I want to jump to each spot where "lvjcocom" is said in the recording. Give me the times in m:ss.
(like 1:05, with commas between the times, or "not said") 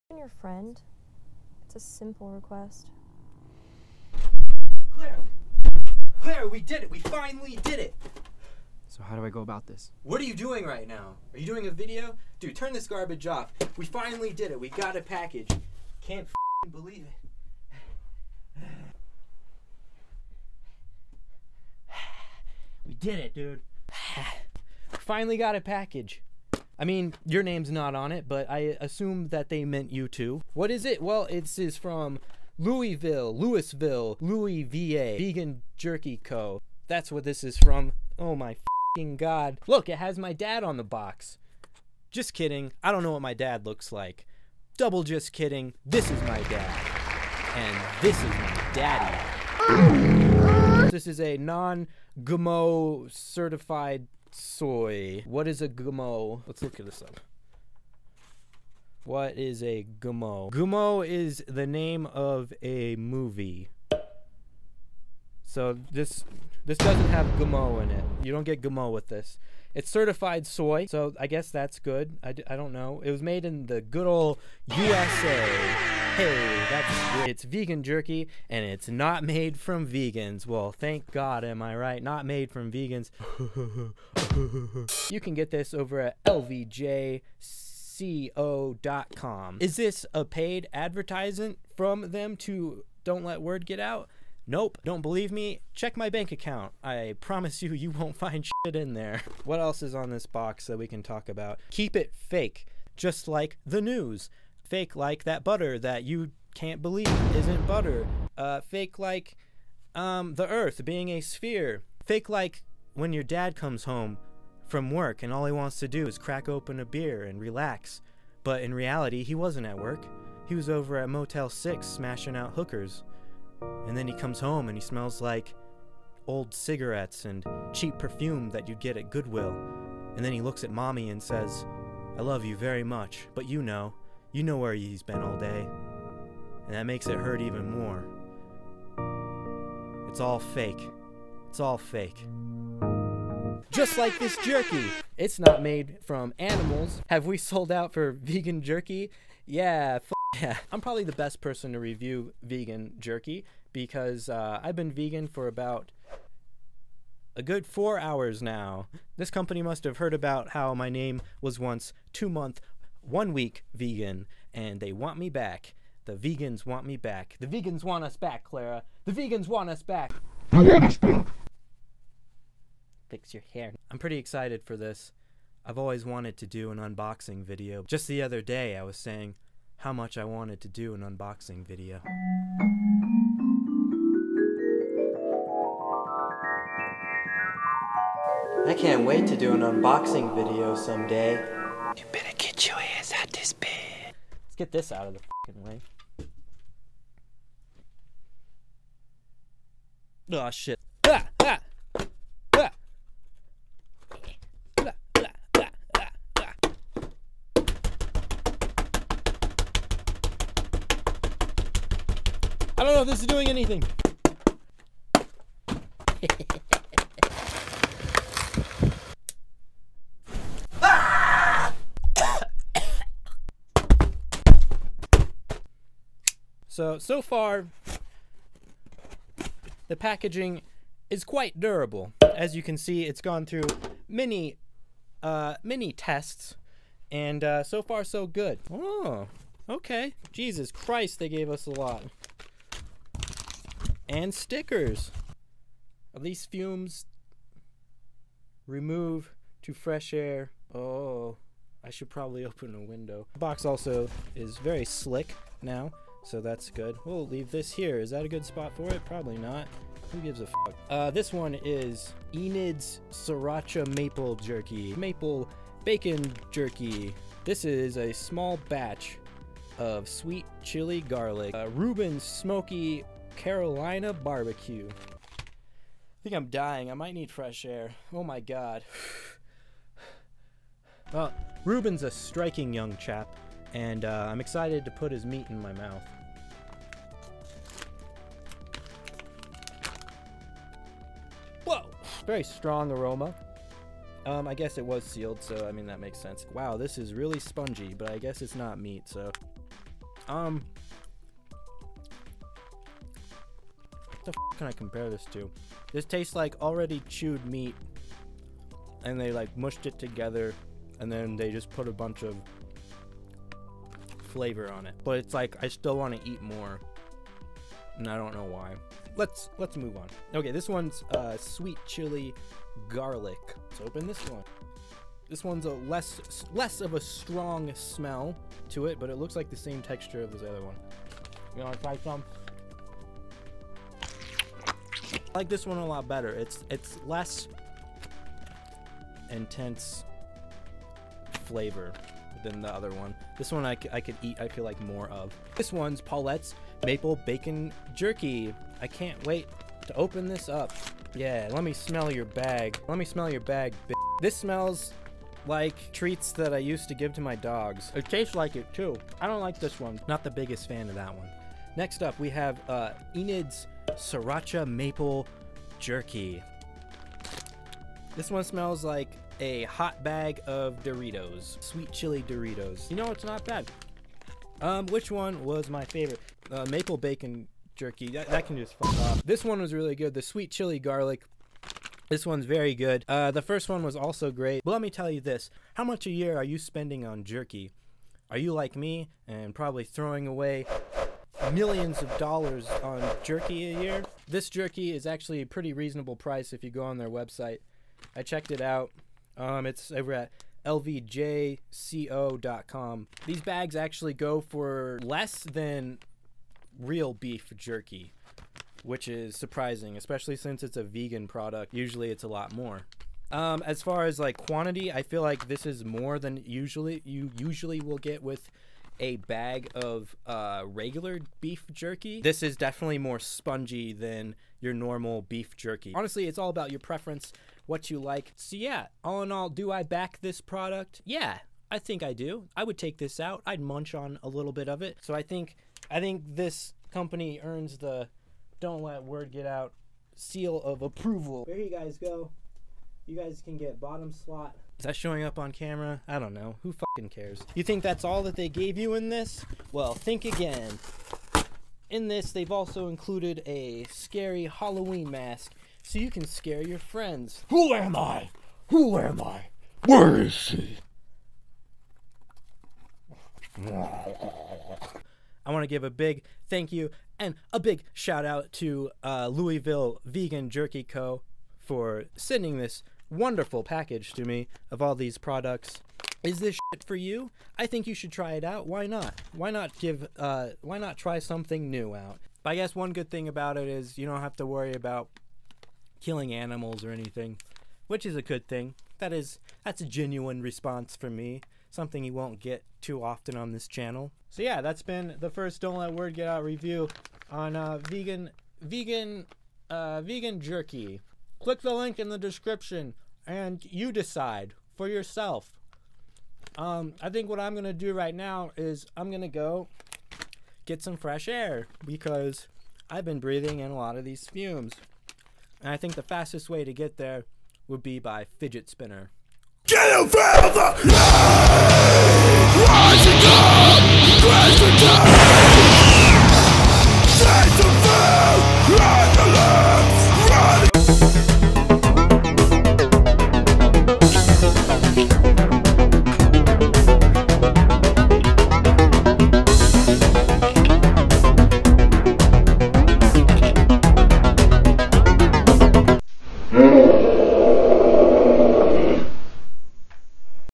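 1:26, 6:40.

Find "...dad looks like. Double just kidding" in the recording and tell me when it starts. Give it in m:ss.
0:43.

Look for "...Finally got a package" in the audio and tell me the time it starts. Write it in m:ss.
0:24.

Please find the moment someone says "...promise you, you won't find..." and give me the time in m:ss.
1:37.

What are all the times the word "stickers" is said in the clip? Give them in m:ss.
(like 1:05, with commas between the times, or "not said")
4:04.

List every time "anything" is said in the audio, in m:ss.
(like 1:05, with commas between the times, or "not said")
3:33, 8:06.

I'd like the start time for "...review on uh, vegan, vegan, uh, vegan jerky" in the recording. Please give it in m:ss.
8:16.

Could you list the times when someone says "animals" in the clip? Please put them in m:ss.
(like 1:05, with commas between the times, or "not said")
2:26, 8:06.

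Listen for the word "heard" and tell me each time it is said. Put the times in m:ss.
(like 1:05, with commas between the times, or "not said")
2:39.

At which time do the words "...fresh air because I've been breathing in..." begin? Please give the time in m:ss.
8:30.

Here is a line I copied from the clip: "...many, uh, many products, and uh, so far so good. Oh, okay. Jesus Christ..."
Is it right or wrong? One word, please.
wrong.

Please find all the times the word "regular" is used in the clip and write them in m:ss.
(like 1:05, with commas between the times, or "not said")
7:00.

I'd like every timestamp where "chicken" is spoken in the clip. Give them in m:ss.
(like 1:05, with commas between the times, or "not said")
not said.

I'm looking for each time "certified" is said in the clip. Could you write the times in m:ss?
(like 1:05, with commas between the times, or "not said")
0:53, 1:09.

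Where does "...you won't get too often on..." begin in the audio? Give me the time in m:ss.
8:12.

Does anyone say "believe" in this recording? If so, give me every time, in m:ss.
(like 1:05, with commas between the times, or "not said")
0:16, 1:35, 1:46.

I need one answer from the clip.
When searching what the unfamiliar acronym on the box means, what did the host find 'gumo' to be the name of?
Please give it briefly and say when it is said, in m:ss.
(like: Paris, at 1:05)
A movie, at 1:01.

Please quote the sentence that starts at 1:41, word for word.
Keep it fake, just like the news.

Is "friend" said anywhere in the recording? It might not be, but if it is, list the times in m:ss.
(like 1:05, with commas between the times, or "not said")
0:00, 7:36.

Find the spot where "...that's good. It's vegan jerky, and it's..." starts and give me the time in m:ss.
1:16.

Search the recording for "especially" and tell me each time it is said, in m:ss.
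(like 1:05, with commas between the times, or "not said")
6:49.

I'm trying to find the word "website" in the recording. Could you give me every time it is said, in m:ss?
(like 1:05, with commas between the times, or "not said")
6:37.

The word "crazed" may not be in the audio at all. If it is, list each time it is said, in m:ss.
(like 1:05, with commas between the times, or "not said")
not said.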